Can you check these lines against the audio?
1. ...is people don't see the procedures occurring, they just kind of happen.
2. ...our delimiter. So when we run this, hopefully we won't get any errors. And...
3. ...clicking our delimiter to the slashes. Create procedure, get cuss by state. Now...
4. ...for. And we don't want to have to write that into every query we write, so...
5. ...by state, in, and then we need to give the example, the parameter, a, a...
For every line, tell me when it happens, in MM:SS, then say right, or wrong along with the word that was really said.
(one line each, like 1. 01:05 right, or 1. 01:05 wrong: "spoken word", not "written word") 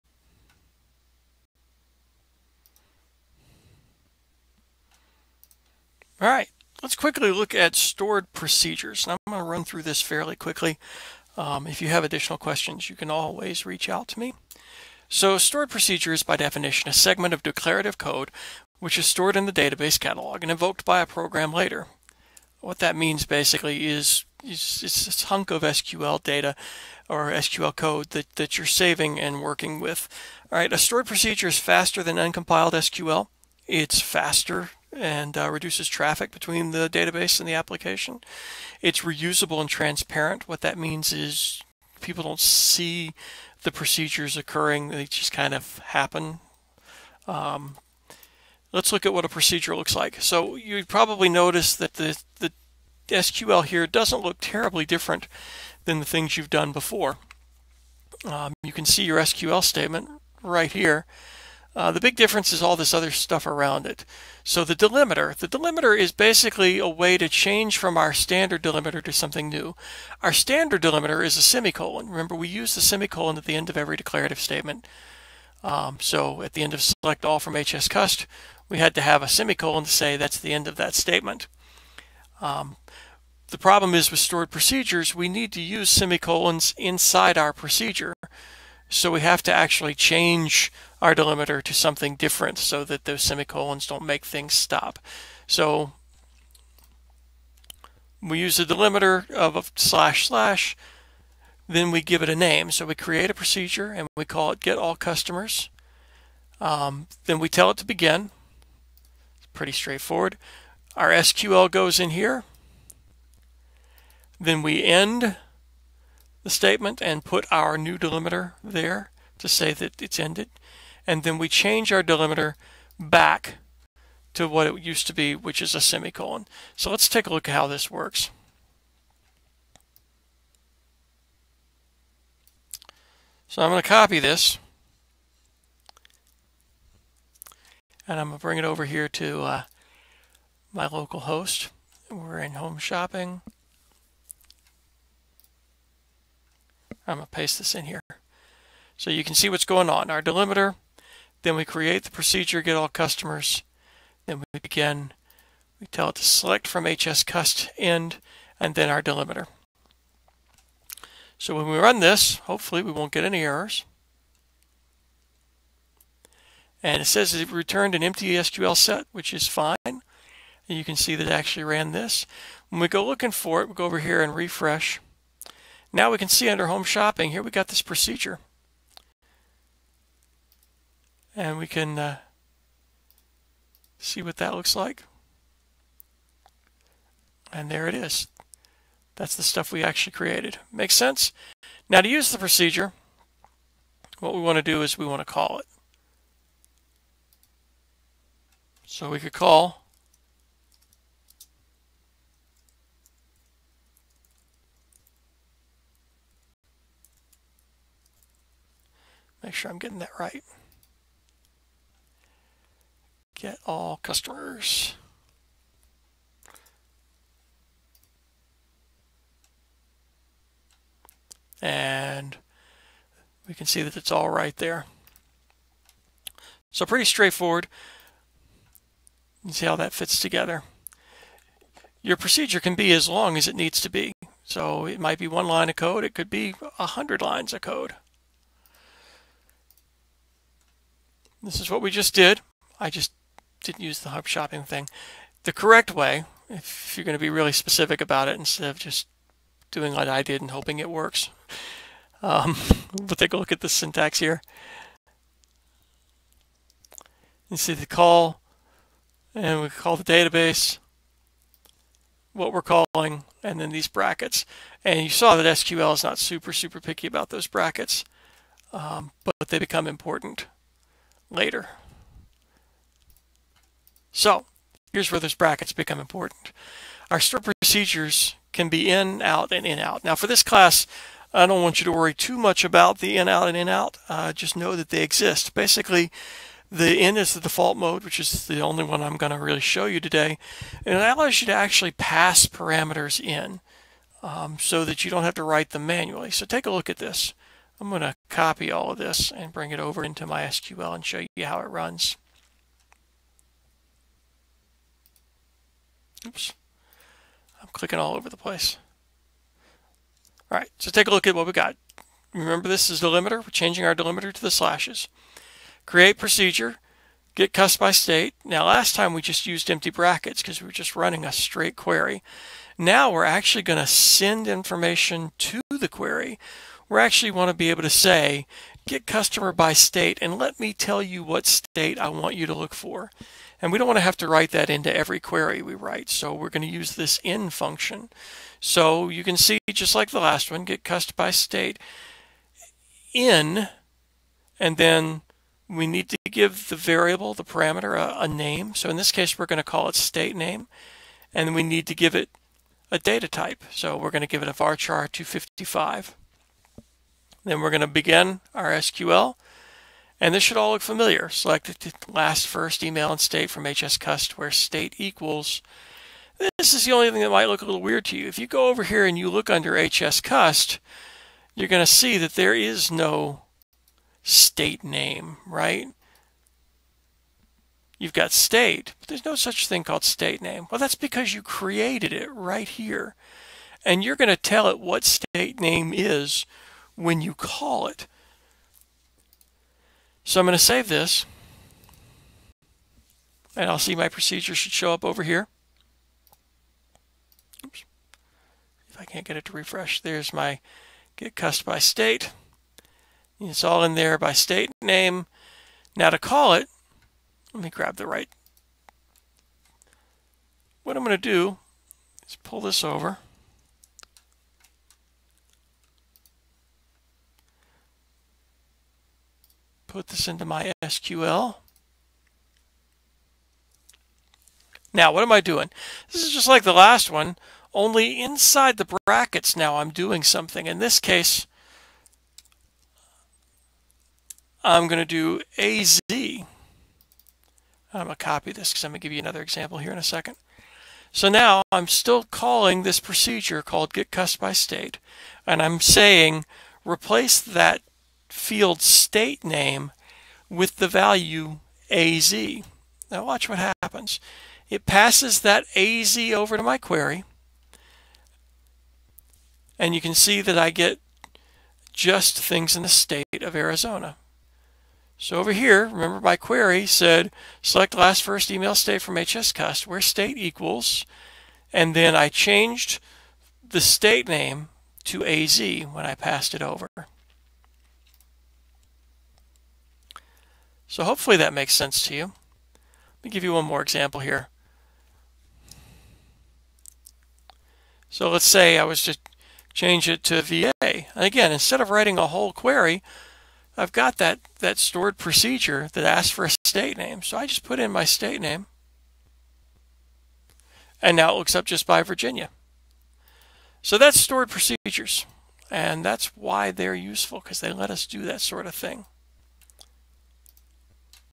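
1. 00:41 right
2. 02:38 right
3. 05:13 wrong: "changing", not "clicking"
4. 05:32 right
5. 05:41 wrong: "variable", not "example".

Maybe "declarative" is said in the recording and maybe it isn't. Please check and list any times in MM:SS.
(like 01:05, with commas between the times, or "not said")
00:17, 01:13.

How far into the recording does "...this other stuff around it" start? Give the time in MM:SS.
01:02.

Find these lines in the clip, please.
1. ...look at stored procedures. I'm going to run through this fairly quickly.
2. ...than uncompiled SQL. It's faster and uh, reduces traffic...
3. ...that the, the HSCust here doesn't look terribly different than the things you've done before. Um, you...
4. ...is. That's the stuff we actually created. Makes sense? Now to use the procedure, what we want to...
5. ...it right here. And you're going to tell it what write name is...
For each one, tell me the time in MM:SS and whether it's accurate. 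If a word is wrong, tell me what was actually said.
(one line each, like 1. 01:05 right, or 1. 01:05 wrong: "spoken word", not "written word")
1. 00:07 right
2. 00:32 right
3. 00:51 wrong: "SQL", not "HSCust"
4. 03:07 right
5. 06:22 wrong: "state", not "write".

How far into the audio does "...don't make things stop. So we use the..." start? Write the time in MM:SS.
01:33.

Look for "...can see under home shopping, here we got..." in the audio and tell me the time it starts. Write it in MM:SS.
02:56.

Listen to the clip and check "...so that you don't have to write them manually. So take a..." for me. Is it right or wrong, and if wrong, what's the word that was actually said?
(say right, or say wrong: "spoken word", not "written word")
right.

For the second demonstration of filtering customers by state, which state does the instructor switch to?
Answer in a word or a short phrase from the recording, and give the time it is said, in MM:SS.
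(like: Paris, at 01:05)
Virginia, at 08:10.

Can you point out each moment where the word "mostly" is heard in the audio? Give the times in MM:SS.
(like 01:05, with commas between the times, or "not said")
not said.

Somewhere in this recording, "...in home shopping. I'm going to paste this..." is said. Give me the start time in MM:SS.
02:22.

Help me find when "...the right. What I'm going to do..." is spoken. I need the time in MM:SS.
06:47.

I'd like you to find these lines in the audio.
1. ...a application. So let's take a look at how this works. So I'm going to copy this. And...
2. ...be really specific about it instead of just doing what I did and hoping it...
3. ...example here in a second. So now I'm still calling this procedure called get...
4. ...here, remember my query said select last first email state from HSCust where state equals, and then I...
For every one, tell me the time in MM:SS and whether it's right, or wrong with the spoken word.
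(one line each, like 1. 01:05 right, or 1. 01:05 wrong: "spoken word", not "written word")
1. 02:05 wrong: "semicolon", not "application"
2. 04:07 right
3. 07:19 right
4. 07:45 right.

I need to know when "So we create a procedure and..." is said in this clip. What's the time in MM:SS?
01:42.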